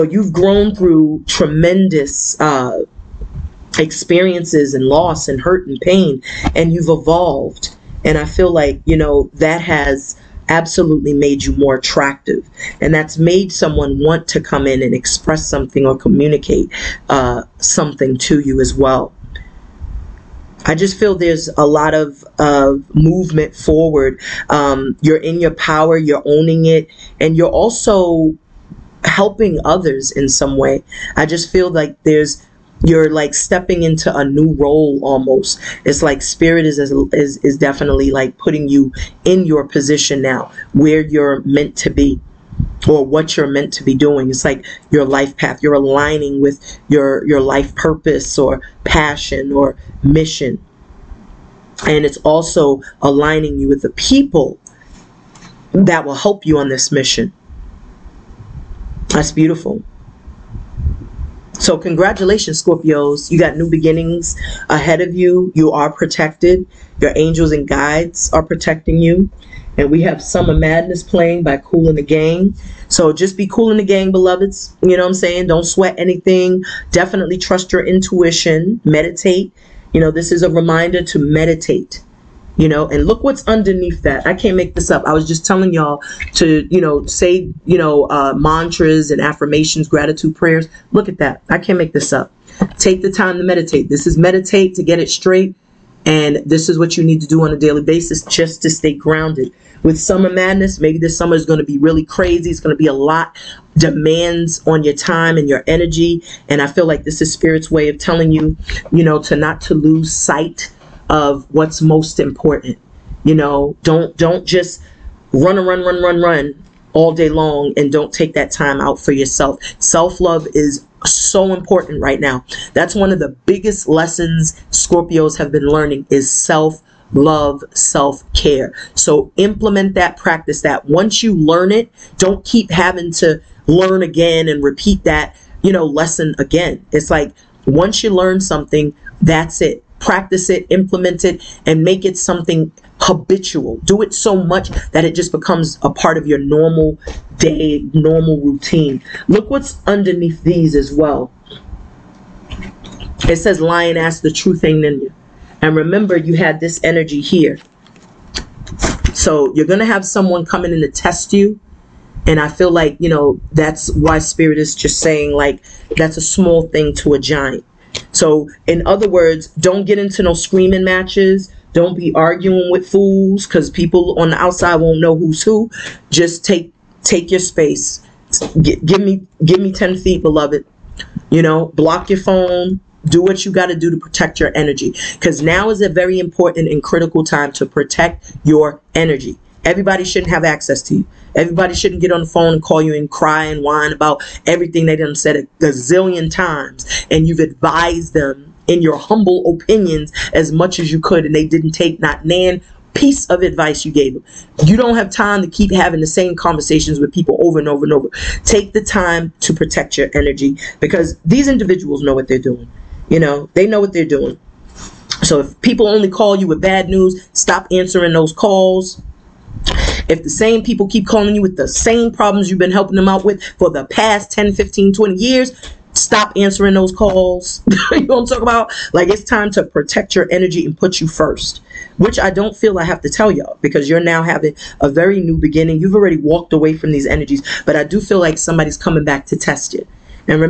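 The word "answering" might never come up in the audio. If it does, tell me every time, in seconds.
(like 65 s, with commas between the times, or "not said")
217 s, 226 s.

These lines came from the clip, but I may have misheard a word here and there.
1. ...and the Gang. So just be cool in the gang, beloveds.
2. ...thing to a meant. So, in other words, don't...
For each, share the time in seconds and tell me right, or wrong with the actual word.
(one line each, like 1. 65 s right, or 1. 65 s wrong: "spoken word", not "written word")
1. 71 s right
2. 166 s wrong: "giant", not "meant".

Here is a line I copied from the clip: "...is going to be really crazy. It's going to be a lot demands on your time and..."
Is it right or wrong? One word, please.
right.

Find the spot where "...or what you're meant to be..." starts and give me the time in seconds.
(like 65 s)
42 s.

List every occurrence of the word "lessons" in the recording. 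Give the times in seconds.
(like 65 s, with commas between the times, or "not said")
123 s, 135 s.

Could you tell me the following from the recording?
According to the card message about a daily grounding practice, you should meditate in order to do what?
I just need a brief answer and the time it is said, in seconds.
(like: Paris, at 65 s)
get it straight, at 94 s.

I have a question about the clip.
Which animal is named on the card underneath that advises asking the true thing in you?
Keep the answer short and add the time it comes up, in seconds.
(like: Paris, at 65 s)
Lion, at 153 s.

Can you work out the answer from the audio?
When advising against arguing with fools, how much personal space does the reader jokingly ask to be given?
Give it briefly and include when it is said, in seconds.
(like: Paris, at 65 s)
10 feet, at 179 s.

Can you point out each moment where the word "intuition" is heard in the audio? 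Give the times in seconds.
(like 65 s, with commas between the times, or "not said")
77 s.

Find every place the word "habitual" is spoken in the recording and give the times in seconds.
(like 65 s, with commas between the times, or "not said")
143 s.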